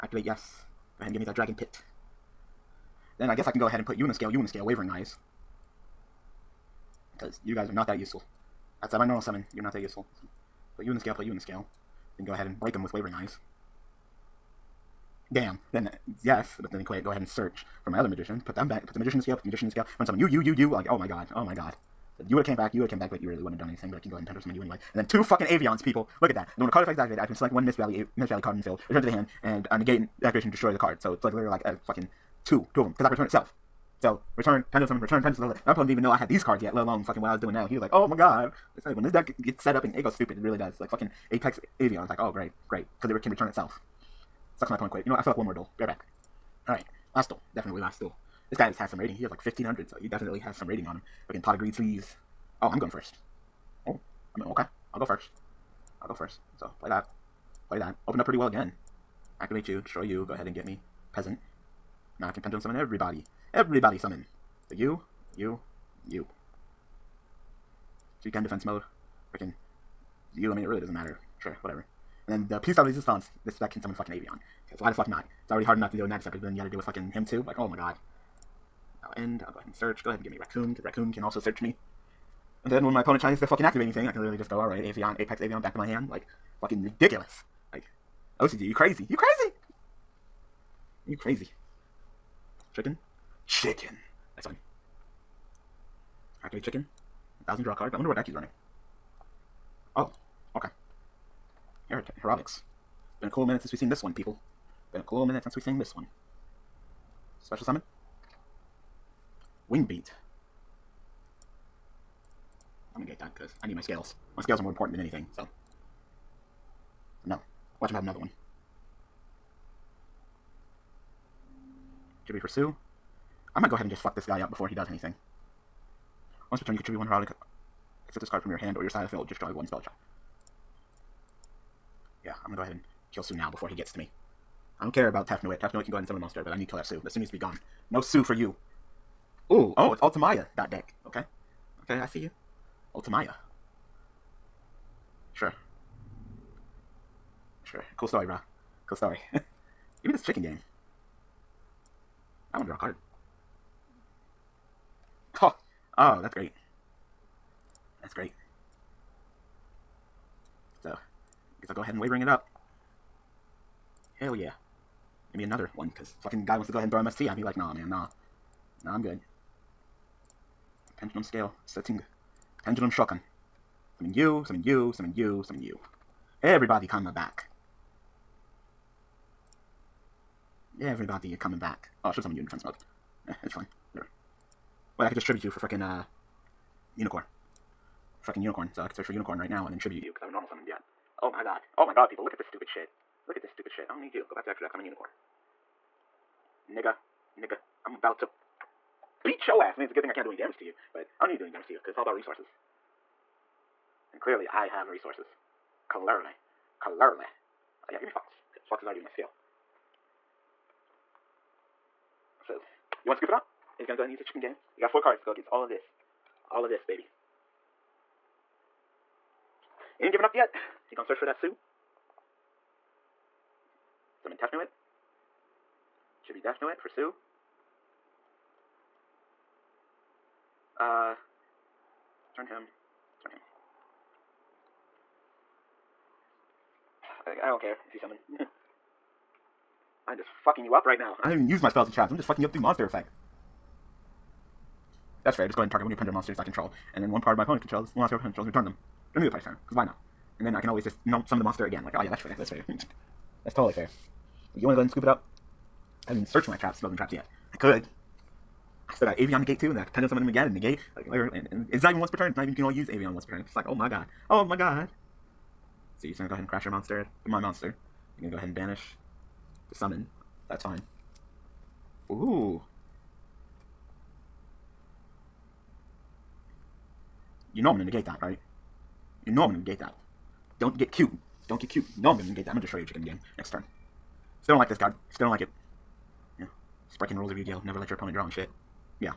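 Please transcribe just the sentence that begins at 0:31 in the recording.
So it's like literally like a fucking two, two of them, because I can return itself.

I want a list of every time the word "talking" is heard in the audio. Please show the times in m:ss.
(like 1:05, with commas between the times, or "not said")
not said.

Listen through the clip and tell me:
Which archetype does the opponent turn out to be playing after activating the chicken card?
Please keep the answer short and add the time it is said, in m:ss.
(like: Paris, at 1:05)
Hieratics, at 1:42.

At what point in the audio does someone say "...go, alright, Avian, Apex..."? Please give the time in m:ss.
1:24.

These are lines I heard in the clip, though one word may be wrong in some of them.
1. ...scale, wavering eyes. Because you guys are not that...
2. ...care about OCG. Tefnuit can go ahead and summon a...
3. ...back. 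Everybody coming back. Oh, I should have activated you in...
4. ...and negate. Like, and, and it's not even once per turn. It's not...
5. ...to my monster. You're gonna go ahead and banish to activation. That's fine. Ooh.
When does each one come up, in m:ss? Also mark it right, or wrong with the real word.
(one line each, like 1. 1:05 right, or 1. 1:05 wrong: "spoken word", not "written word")
1. 0:04 right
2. 2:14 wrong: "Tefnuit", not "OCG"
3. 2:57 wrong: "summoned", not "activated"
4. 4:20 right
5. 4:27 wrong: "summon", not "activation".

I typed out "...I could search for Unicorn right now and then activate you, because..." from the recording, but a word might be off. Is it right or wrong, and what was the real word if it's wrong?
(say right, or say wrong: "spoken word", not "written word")
wrong: "tribute", not "activate".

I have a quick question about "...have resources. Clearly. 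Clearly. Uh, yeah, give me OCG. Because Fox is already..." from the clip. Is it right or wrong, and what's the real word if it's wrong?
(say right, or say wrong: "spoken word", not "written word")
wrong: "Fox", not "OCG".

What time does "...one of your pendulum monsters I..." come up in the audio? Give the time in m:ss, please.
4:05.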